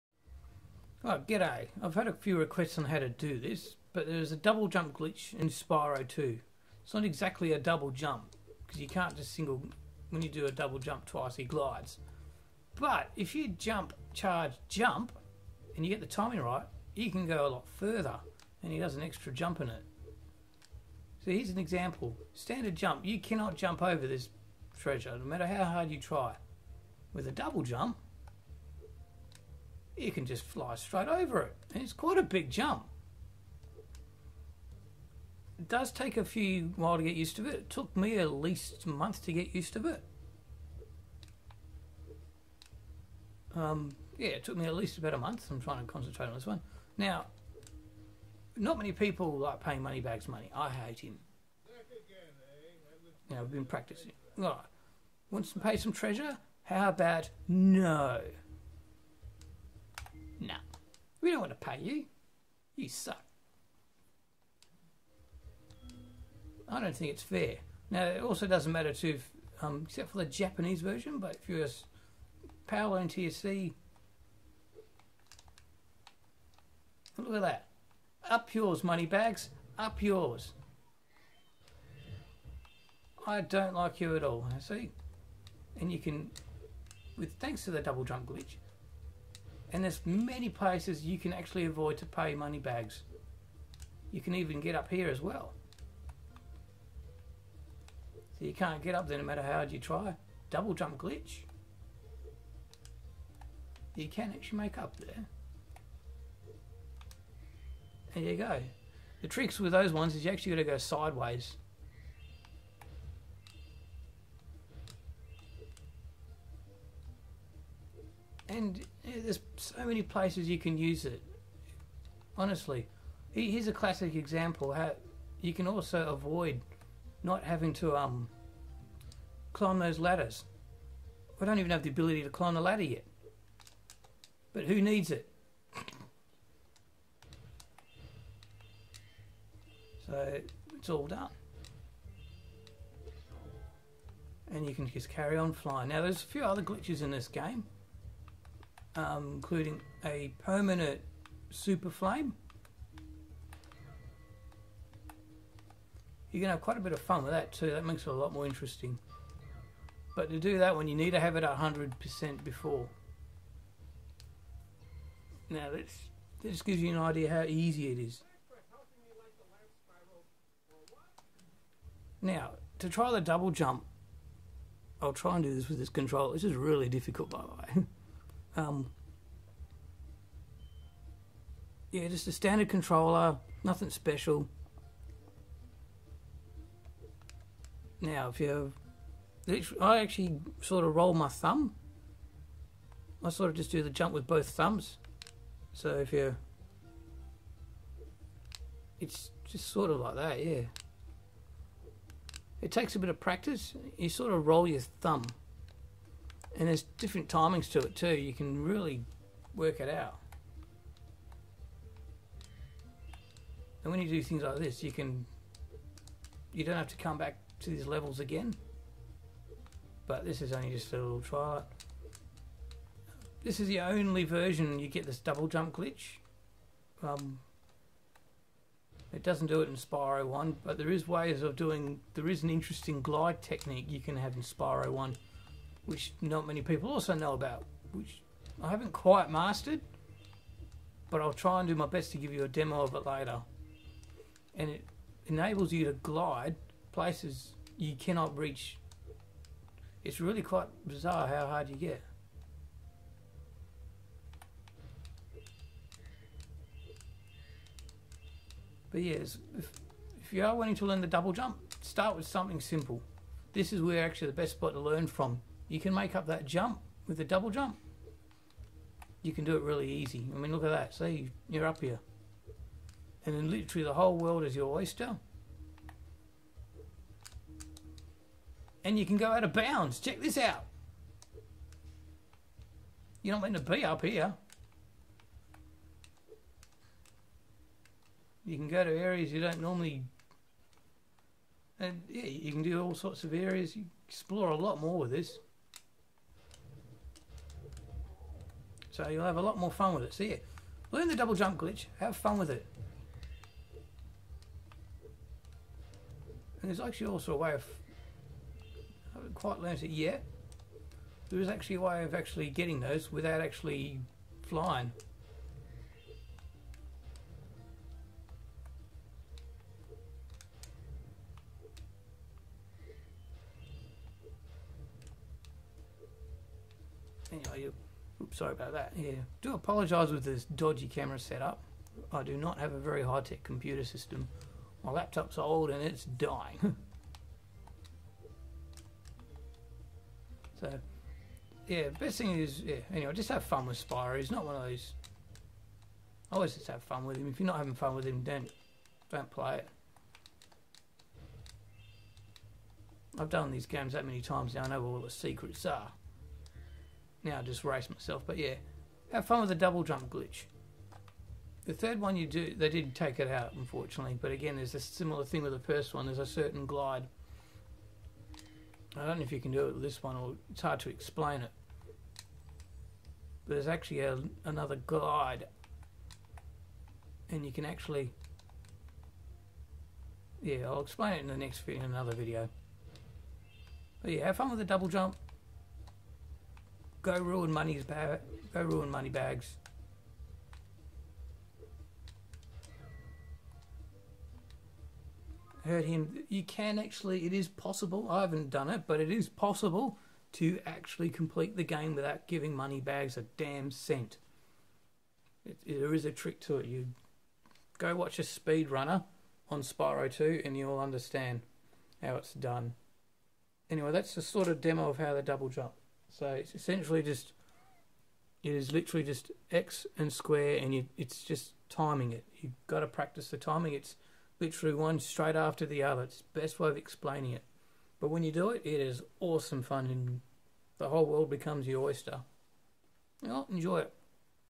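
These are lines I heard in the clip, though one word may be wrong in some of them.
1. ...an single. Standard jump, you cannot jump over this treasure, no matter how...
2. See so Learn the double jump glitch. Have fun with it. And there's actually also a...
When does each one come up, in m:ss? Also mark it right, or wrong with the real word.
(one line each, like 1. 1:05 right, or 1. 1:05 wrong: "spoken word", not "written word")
1. 0:21 wrong: "example", not "single"
2. 5:00 right.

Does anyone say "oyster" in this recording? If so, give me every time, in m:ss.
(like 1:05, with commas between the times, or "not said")
4:34, 7:11.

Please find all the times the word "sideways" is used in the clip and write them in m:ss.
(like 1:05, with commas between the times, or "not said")
1:50.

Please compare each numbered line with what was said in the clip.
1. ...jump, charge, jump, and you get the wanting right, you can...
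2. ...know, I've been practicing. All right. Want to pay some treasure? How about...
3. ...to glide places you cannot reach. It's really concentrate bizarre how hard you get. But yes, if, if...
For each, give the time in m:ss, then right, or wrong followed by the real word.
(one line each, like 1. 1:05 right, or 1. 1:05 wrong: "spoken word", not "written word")
1. 0:13 wrong: "timing", not "wanting"
2. 0:53 right
3. 4:05 wrong: "quite", not "concentrate".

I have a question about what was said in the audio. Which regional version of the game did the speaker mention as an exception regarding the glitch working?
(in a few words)
Japanese version.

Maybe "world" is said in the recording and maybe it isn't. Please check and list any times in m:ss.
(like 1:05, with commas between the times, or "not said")
4:34, 7:11.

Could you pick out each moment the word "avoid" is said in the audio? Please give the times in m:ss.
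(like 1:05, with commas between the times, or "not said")
1:31, 2:06.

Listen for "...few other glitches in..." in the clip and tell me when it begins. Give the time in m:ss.
2:26.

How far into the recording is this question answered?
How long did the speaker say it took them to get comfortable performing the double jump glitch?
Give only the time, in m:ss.
0:38.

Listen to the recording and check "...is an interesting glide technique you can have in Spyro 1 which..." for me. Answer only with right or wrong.
right.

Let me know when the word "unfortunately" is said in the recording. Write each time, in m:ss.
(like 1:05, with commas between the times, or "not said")
6:03.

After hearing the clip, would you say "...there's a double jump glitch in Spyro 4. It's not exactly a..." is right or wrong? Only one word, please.
wrong.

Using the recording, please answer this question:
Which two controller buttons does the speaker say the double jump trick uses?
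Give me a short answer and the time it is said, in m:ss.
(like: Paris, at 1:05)
X and square, at 6:59.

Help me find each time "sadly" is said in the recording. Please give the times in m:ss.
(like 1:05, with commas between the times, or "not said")
not said.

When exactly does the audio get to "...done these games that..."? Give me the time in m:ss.
5:53.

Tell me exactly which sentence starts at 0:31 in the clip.
And it's quite a big jump.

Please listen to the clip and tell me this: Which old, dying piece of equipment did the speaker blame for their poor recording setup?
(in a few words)
Laptop.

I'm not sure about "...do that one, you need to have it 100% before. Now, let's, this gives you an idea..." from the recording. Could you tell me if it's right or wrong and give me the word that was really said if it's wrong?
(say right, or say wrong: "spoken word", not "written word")
right.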